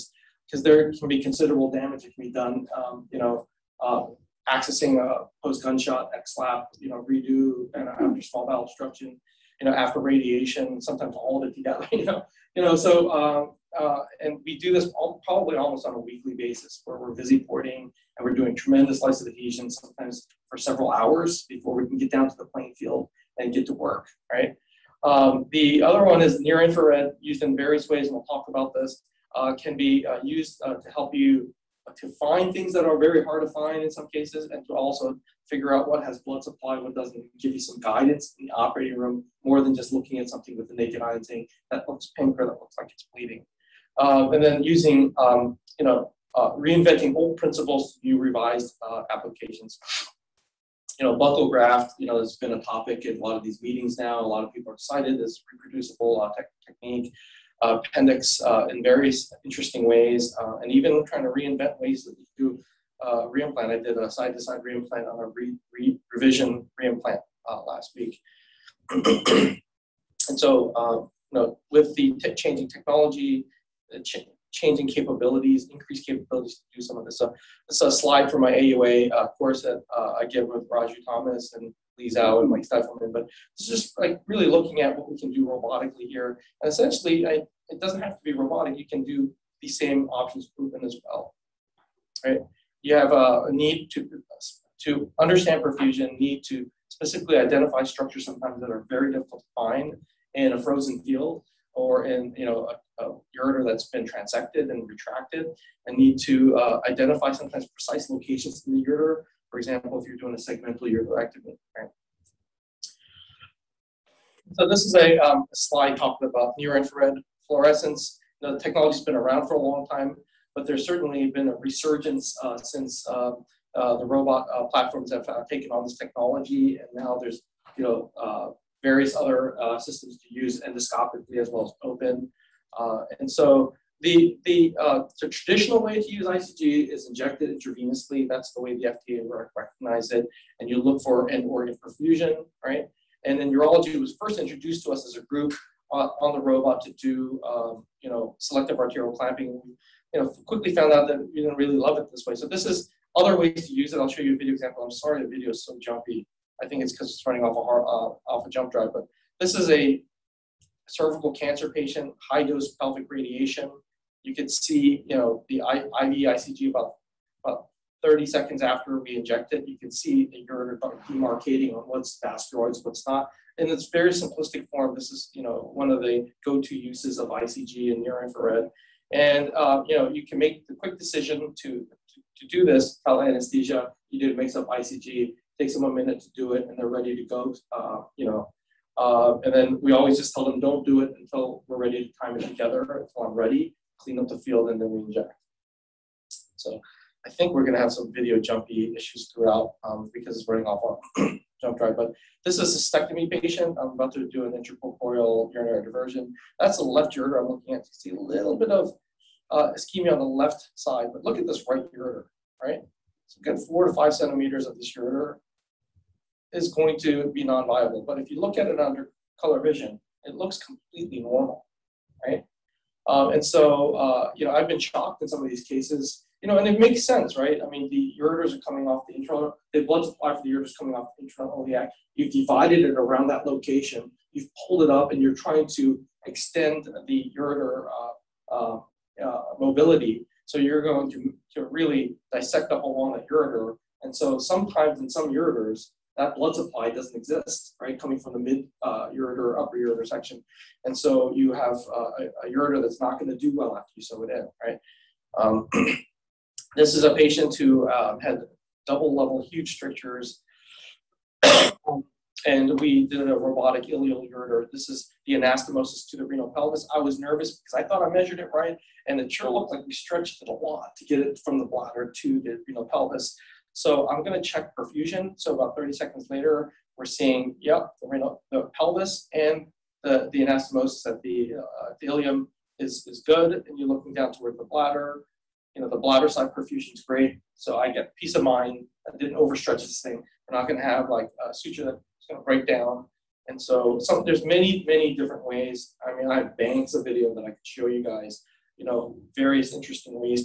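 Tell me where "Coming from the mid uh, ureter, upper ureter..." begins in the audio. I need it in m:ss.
4:07.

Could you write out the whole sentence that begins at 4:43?
And you're looking down toward the bladder.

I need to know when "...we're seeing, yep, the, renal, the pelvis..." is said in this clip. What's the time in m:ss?
4:36.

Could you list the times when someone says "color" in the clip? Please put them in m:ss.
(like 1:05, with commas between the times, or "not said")
3:39.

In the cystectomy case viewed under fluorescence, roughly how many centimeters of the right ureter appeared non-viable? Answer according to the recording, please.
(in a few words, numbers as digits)
4 to 5 centimeters.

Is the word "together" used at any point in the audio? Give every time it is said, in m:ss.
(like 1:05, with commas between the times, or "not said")
0:11, 3:12.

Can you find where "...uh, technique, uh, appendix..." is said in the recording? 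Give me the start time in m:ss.
0:56.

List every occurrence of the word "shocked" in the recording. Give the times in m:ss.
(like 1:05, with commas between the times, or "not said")
3:44.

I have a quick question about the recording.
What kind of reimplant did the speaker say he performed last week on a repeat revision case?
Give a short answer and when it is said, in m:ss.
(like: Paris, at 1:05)
Side-to-side reimplant, at 1:04.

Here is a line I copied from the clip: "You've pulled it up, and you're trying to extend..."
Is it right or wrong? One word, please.
right.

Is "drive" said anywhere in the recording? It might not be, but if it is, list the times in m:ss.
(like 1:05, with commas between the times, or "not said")
2:38, 3:21.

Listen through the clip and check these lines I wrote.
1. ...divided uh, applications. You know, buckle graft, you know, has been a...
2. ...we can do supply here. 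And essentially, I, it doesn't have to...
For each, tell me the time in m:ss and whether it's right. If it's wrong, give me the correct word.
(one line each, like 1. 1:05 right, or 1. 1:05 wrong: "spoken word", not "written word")
1. 0:48 wrong: "revised", not "divided"
2. 1:25 wrong: "robotically", not "supply".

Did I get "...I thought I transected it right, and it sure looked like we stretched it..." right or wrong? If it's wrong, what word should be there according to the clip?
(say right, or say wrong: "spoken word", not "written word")
wrong: "measured", not "transected".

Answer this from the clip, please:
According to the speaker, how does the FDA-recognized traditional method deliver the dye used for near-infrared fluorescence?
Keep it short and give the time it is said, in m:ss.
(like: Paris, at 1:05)
Intravenously, at 2:17.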